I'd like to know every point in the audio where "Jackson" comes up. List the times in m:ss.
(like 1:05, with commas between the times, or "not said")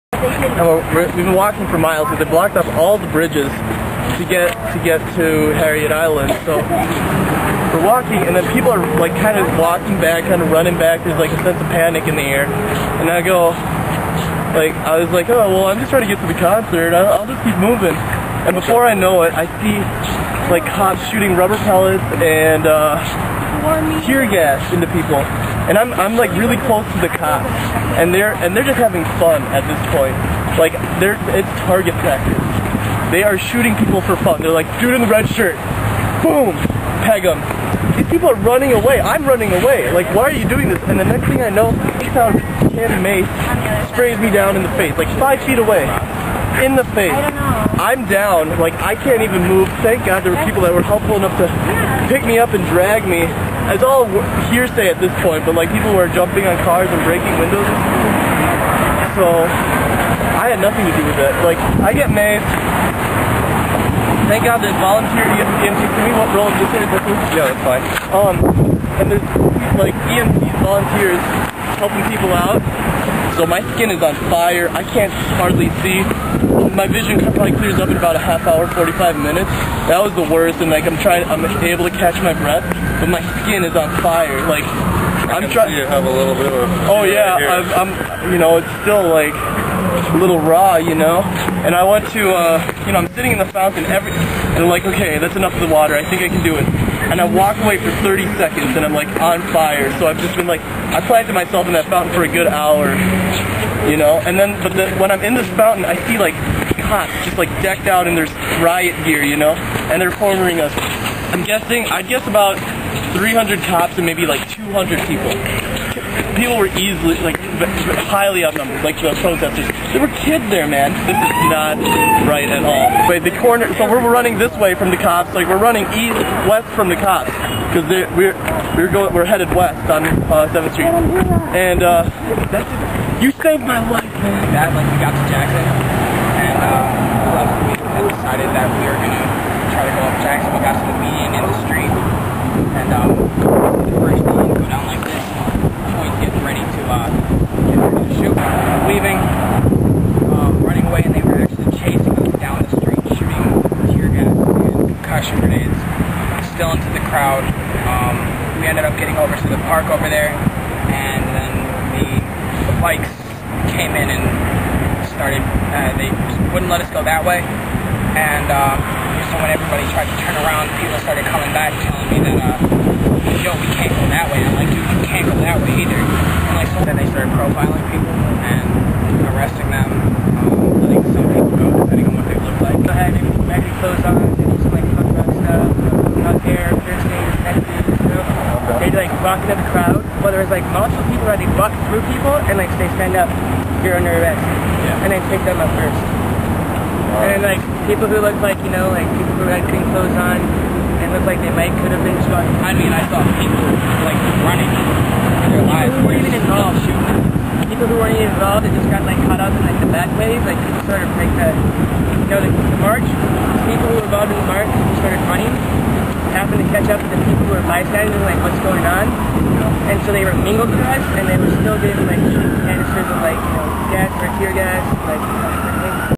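2:15, 2:20.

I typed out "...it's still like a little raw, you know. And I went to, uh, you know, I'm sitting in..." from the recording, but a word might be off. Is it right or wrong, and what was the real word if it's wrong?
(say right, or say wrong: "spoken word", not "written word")
right.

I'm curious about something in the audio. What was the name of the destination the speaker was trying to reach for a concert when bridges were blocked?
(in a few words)
Harriet Island.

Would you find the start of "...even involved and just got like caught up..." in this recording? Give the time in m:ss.
3:28.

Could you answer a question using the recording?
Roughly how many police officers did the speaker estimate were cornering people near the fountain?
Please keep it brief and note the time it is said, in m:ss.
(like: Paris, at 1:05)
300, at 1:53.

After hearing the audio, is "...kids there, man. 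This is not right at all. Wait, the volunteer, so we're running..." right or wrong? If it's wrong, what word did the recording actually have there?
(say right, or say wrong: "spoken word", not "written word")
wrong: "corner", not "volunteer".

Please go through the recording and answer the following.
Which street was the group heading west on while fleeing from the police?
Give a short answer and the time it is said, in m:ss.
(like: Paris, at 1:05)
7th Street, at 2:10.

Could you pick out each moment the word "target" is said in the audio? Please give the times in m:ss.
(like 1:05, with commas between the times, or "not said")
0:31.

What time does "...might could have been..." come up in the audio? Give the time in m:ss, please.
3:21.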